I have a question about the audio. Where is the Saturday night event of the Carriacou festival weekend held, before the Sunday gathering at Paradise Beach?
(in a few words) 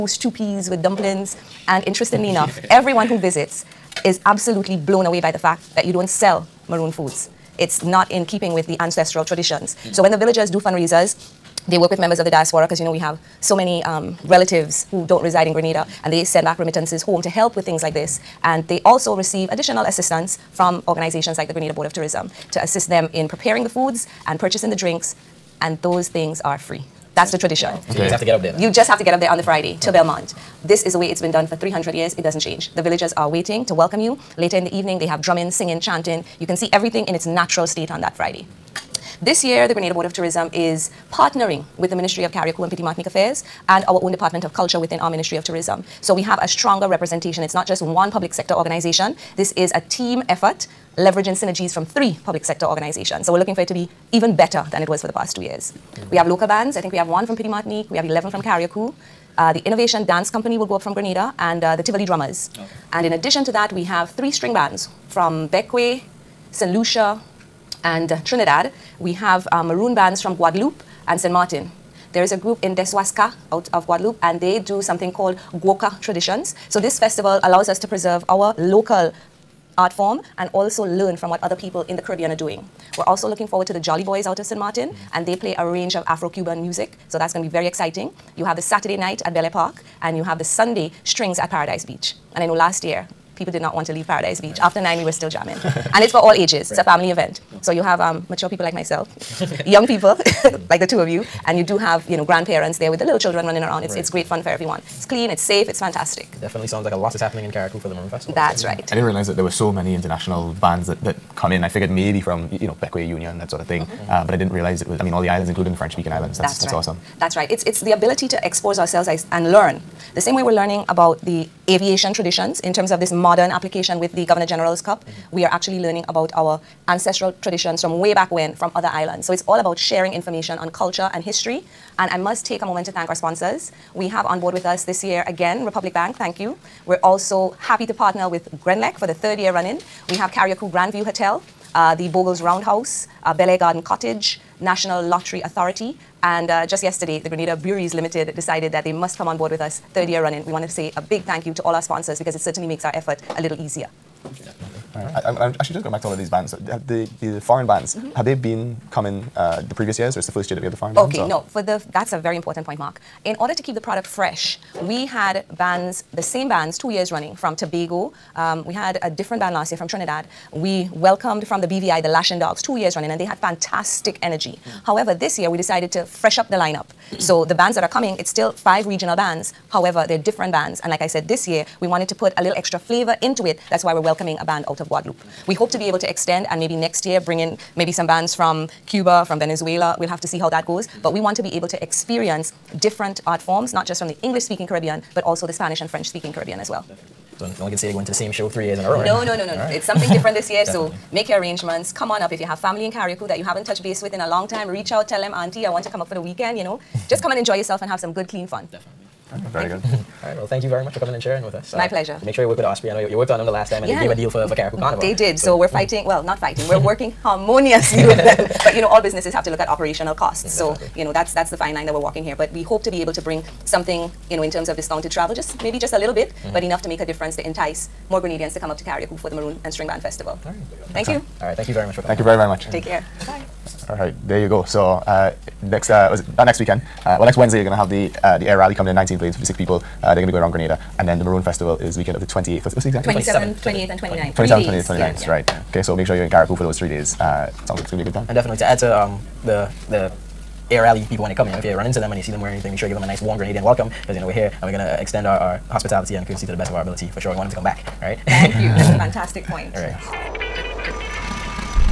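Belle Park.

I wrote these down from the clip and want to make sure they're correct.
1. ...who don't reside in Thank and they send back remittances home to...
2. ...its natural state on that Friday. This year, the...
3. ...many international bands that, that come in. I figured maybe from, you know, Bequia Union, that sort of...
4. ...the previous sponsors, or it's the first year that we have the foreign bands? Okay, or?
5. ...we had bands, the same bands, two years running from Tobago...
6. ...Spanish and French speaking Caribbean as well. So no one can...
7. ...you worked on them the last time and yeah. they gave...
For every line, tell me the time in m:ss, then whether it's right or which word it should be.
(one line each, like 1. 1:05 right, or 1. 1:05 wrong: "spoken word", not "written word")
1. 0:14 wrong: "Grenada", not "Thank"
2. 0:37 right
3. 1:49 right
4. 2:39 wrong: "years", not "sponsors"
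5. 2:44 right
6. 3:15 right
7. 3:33 right.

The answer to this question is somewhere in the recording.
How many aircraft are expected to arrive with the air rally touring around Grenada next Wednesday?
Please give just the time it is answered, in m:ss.
3:58.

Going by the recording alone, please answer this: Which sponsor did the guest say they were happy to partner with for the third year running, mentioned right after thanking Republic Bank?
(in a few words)
Grenlec.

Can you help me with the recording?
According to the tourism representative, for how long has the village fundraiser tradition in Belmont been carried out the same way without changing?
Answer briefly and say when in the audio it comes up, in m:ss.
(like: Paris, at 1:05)
300 years, at 0:31.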